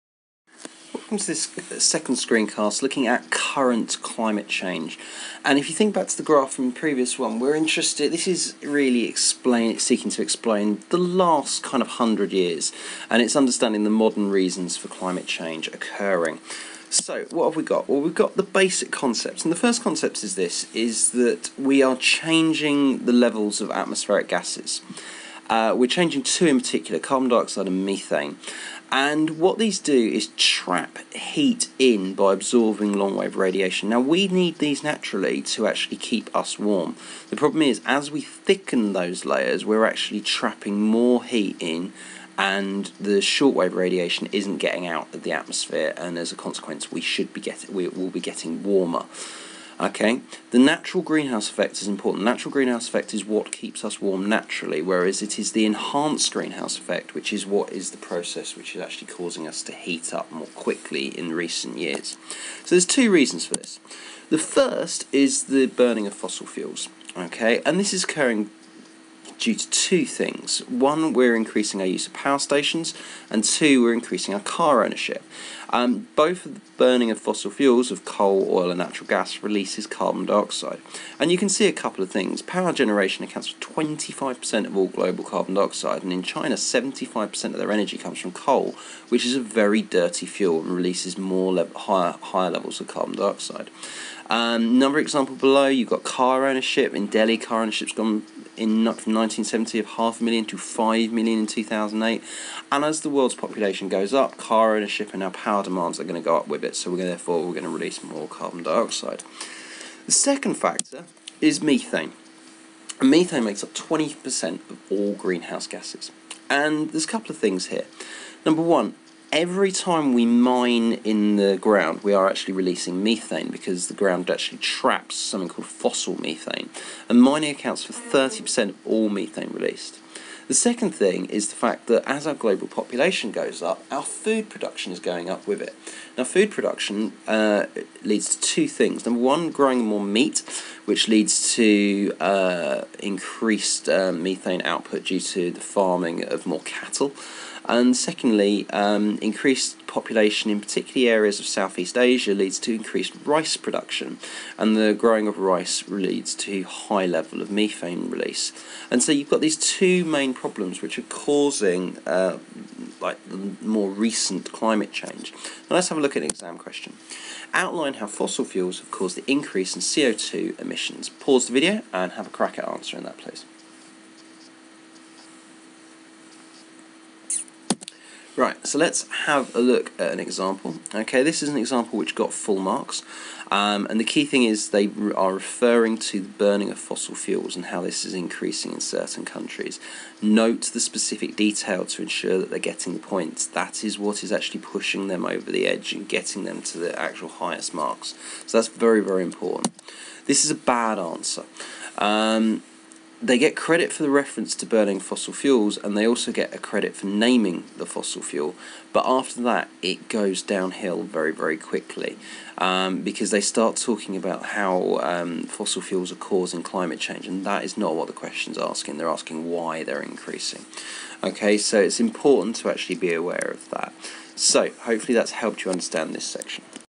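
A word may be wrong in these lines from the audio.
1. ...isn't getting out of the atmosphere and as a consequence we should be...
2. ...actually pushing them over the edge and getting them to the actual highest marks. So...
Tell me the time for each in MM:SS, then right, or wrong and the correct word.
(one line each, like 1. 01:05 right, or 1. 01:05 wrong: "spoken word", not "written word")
1. 00:44 right
2. 03:14 right.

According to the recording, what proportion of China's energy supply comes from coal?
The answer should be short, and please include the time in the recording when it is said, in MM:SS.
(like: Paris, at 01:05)
75%, at 01:26.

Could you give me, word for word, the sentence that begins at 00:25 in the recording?
Uh, we're changing two in particular, carbon dioxide and methane.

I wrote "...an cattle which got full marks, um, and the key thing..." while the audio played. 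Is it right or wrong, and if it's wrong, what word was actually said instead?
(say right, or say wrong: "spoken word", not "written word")
wrong: "example", not "cattle".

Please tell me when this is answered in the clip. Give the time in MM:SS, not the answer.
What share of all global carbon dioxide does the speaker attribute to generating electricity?
01:23.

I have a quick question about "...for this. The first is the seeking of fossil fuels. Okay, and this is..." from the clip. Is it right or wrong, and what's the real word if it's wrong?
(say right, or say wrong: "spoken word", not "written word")
wrong: "burning", not "seeking".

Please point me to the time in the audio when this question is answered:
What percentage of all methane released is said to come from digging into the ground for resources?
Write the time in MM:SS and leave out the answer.
02:07.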